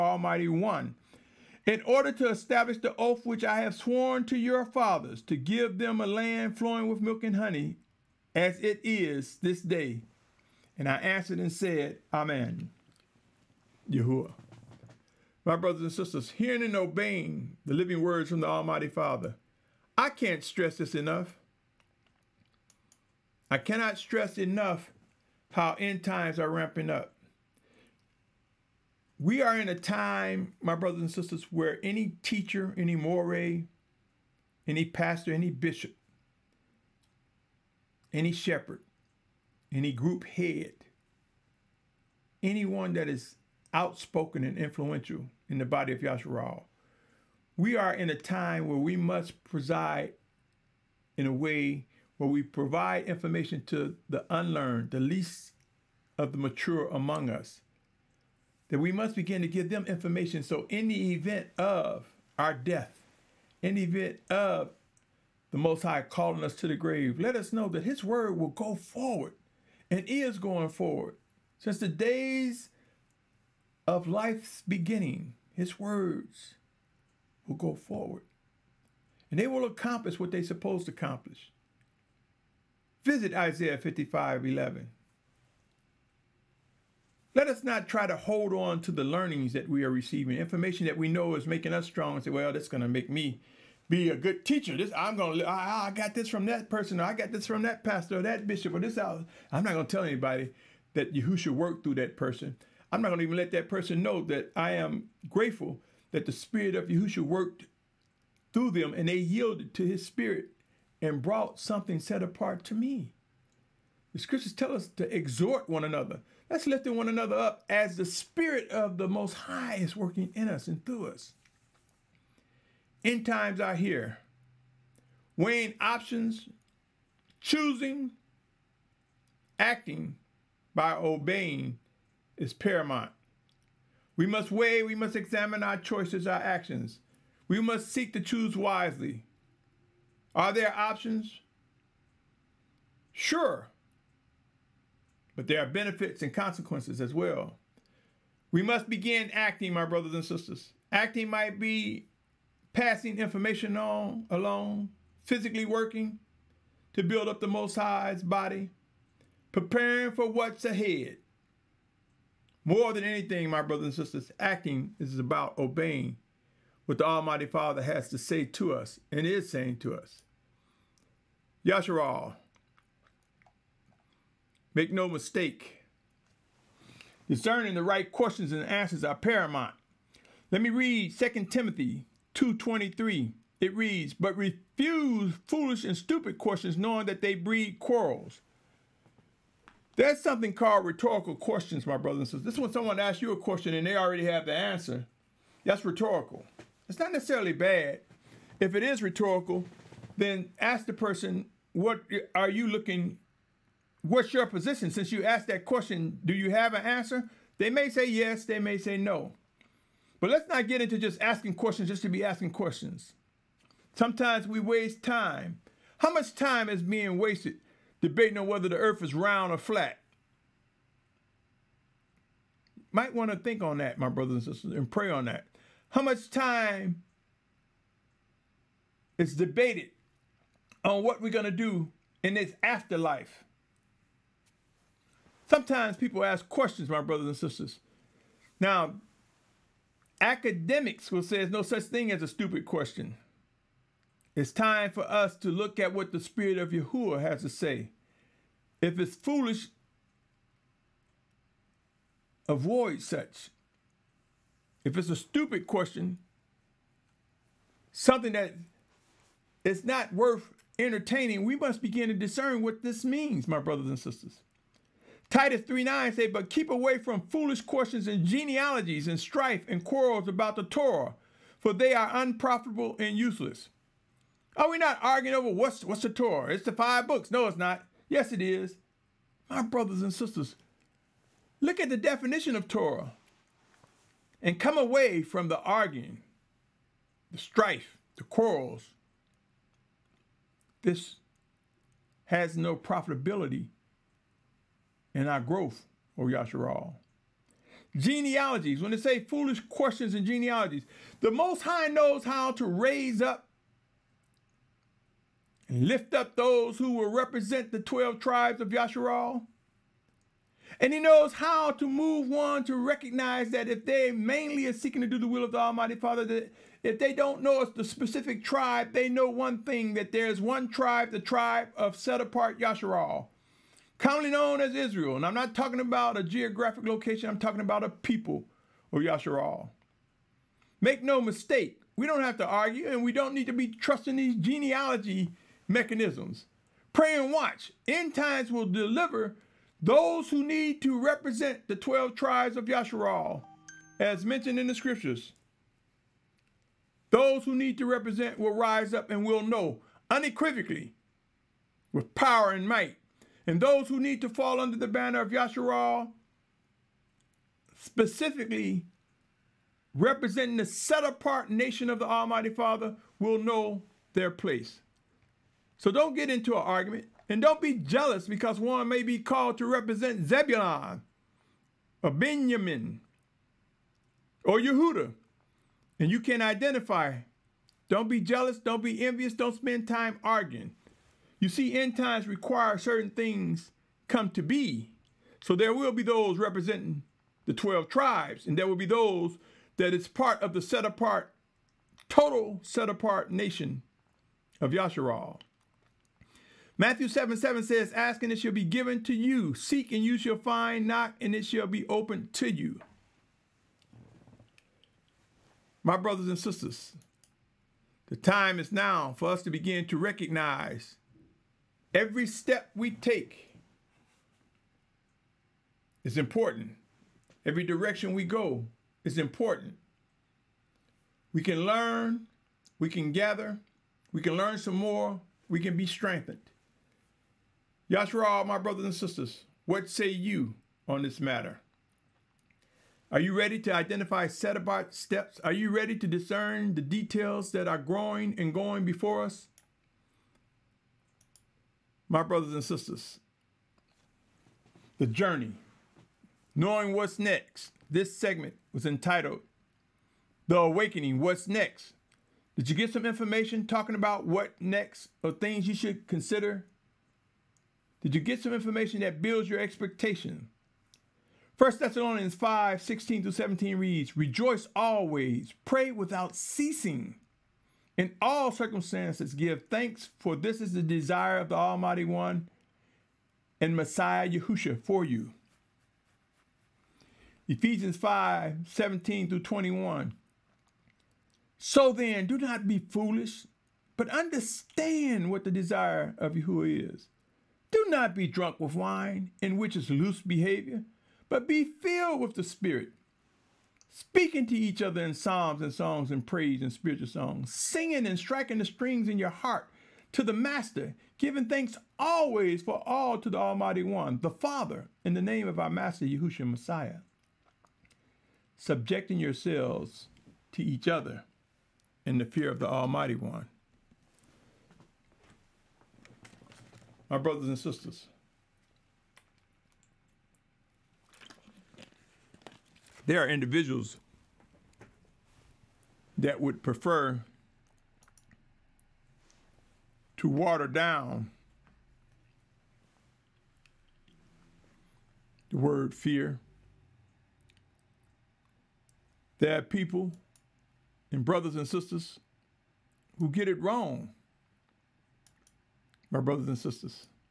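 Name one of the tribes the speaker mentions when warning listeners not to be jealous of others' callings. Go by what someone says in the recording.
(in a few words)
Zebulon.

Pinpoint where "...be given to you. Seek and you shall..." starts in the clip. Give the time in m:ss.
6:38.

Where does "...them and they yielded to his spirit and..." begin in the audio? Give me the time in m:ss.
1:48.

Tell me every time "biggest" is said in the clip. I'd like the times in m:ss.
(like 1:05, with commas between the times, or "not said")
not said.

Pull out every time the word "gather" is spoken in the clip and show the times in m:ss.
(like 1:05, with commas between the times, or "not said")
7:03.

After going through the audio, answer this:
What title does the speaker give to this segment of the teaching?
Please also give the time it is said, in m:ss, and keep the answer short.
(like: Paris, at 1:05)
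The Awakening, What's Next?, at 7:30.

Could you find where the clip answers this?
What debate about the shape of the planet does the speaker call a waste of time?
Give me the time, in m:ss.
3:39.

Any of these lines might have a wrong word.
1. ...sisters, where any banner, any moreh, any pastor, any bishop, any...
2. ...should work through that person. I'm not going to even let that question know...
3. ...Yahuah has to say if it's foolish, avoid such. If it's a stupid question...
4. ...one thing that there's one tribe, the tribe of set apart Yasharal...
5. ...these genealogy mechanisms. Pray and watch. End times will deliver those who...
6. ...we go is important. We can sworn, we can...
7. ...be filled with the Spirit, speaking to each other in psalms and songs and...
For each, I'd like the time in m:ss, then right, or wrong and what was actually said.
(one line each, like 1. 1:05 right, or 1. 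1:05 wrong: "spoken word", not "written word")
1. 0:31 wrong: "teacher", not "banner"
2. 1:41 wrong: "person", not "question"
3. 4:06 right
4. 5:19 right
5. 5:34 right
6. 6:58 wrong: "learn", not "sworn"
7. 8:11 right.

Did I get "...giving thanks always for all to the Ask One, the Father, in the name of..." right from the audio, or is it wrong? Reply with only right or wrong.
wrong.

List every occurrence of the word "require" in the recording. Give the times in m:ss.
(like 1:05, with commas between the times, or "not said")
6:22.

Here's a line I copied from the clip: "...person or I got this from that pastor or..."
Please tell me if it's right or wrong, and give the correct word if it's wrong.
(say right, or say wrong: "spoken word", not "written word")
right.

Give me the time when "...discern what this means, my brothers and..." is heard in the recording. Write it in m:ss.
4:22.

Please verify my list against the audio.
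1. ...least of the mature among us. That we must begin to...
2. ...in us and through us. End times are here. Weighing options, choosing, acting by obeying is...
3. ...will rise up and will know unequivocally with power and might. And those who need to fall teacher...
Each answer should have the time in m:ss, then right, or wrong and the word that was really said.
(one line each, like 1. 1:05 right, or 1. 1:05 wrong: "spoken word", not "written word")
1. 0:55 right
2. 2:00 right
3. 5:48 wrong: "under", not "teacher".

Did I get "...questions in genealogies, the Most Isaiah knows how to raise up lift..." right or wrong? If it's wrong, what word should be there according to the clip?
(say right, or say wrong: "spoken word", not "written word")
wrong: "High", not "Isaiah".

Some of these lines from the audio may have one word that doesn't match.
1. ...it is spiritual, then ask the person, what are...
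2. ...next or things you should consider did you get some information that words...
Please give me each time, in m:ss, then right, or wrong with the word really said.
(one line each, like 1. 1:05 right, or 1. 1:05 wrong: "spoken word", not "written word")
1. 3:18 wrong: "rhetorical", not "spiritual"
2. 7:34 wrong: "builds", not "words".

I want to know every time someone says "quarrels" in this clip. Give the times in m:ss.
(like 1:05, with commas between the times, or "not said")
3:07, 4:29, 4:48.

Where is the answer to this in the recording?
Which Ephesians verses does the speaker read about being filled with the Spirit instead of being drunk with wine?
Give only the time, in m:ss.
7:57.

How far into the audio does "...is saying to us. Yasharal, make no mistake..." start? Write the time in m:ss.
2:49.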